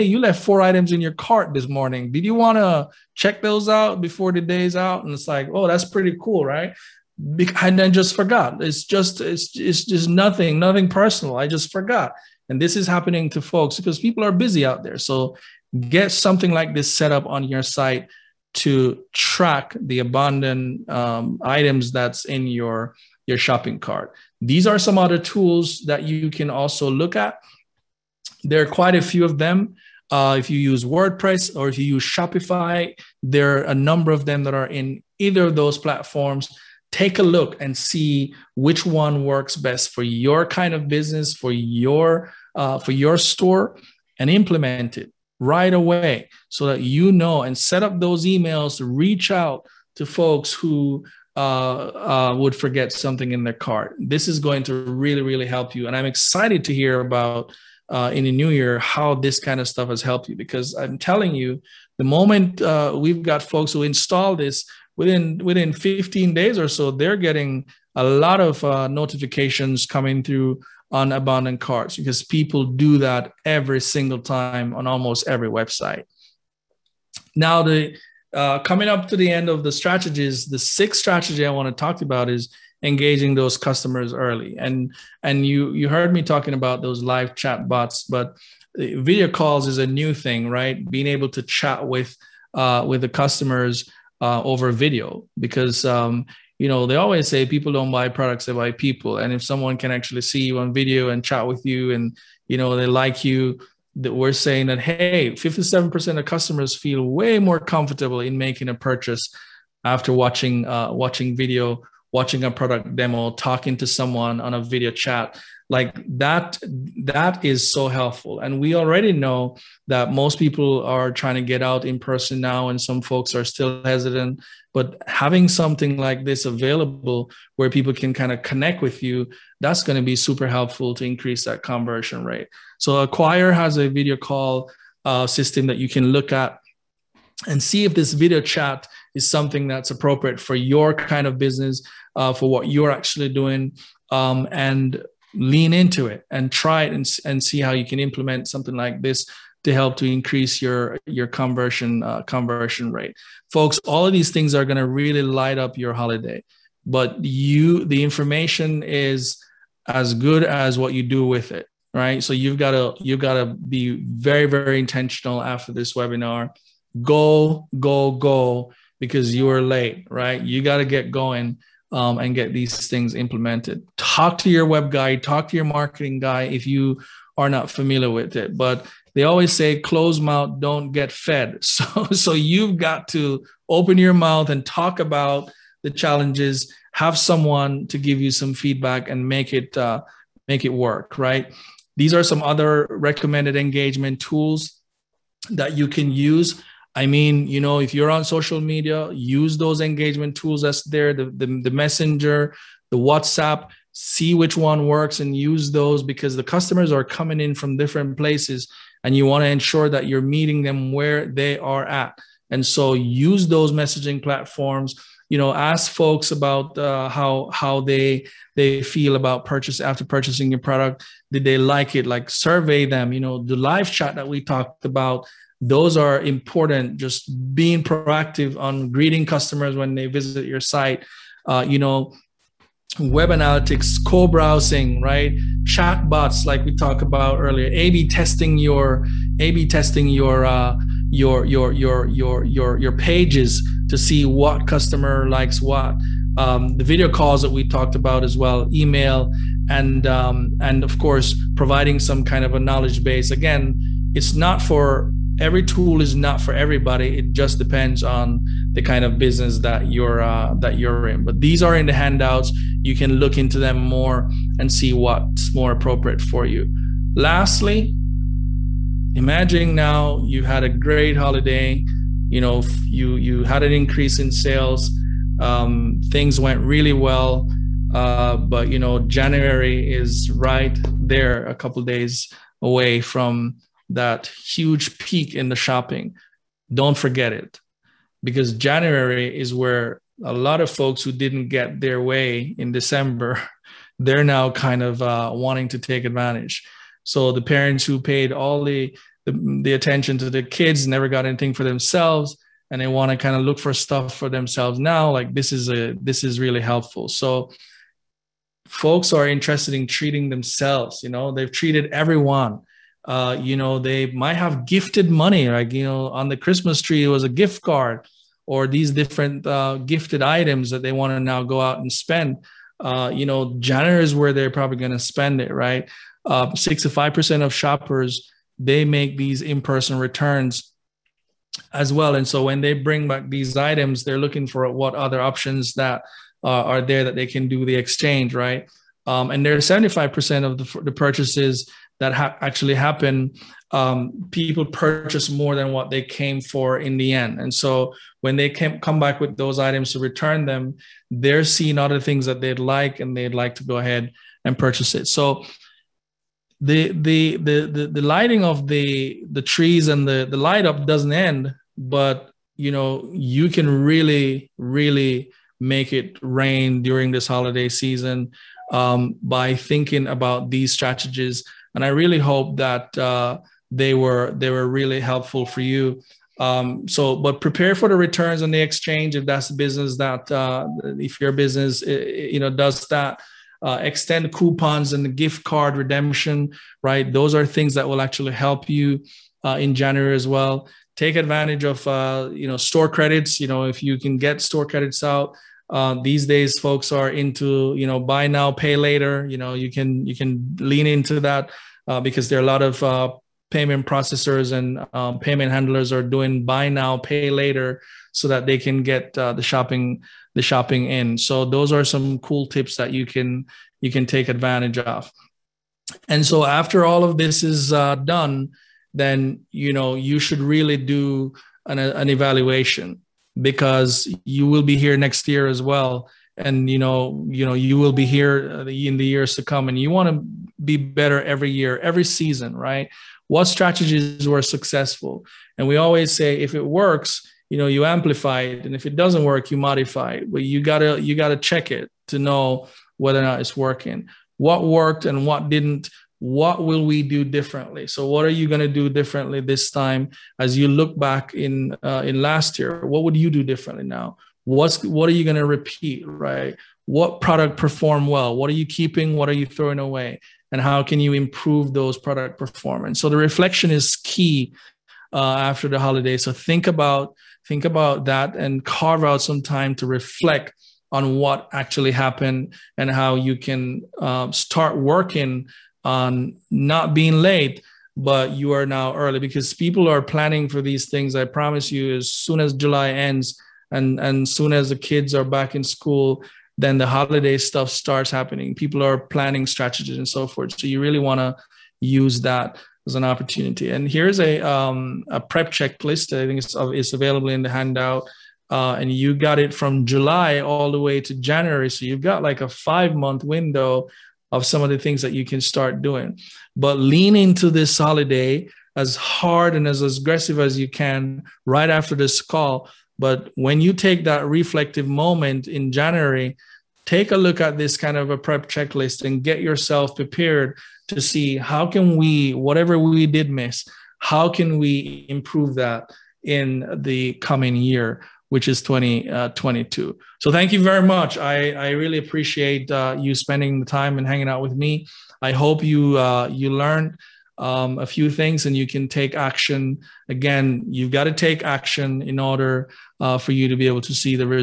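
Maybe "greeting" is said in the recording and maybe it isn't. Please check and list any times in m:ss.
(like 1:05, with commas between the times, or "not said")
3:48.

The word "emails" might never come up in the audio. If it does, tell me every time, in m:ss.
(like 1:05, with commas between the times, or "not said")
0:48, 4:08.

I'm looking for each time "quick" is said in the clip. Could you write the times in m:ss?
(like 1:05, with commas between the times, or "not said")
not said.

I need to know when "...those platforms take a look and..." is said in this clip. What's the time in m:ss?
0:35.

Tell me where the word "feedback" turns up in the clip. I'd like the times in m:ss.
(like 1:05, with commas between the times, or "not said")
3:08.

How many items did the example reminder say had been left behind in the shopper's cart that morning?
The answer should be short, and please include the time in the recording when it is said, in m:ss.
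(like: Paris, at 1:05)
4, at 0:00.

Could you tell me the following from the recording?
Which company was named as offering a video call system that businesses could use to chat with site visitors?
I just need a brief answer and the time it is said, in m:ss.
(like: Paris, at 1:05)
Acquire, at 2:13.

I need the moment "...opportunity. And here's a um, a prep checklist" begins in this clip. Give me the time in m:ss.
8:13.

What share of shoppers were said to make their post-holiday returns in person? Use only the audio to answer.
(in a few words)
65%.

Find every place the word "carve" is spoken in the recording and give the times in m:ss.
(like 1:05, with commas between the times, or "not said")
7:48.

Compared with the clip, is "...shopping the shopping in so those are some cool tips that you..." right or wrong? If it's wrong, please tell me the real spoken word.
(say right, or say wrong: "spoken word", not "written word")
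right.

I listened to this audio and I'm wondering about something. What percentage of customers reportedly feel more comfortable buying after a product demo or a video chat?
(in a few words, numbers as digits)
57%.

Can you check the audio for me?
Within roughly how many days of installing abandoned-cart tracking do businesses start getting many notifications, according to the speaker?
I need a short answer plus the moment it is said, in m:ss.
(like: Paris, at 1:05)
15 days, at 1:05.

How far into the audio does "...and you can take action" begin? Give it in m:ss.
8:58.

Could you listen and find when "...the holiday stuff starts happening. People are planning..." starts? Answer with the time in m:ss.
8:06.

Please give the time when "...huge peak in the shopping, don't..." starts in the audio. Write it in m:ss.
4:44.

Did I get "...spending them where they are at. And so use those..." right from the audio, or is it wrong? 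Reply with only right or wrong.
wrong.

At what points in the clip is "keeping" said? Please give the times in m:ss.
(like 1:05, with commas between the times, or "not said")
7:38.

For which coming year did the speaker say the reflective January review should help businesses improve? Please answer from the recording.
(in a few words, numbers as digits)
2022.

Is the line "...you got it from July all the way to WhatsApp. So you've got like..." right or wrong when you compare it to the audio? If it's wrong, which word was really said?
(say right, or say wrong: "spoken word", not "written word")
wrong: "January", not "WhatsApp".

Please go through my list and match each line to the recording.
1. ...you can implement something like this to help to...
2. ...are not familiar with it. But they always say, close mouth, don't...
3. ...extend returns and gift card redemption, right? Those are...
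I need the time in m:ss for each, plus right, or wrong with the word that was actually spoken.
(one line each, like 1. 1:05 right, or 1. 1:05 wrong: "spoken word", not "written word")
1. 2:27 right
2. 2:57 right
3. 6:23 wrong: "coupons", not "returns".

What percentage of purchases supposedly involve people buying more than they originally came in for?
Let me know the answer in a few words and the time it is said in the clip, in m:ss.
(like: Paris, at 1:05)
75%, at 5:39.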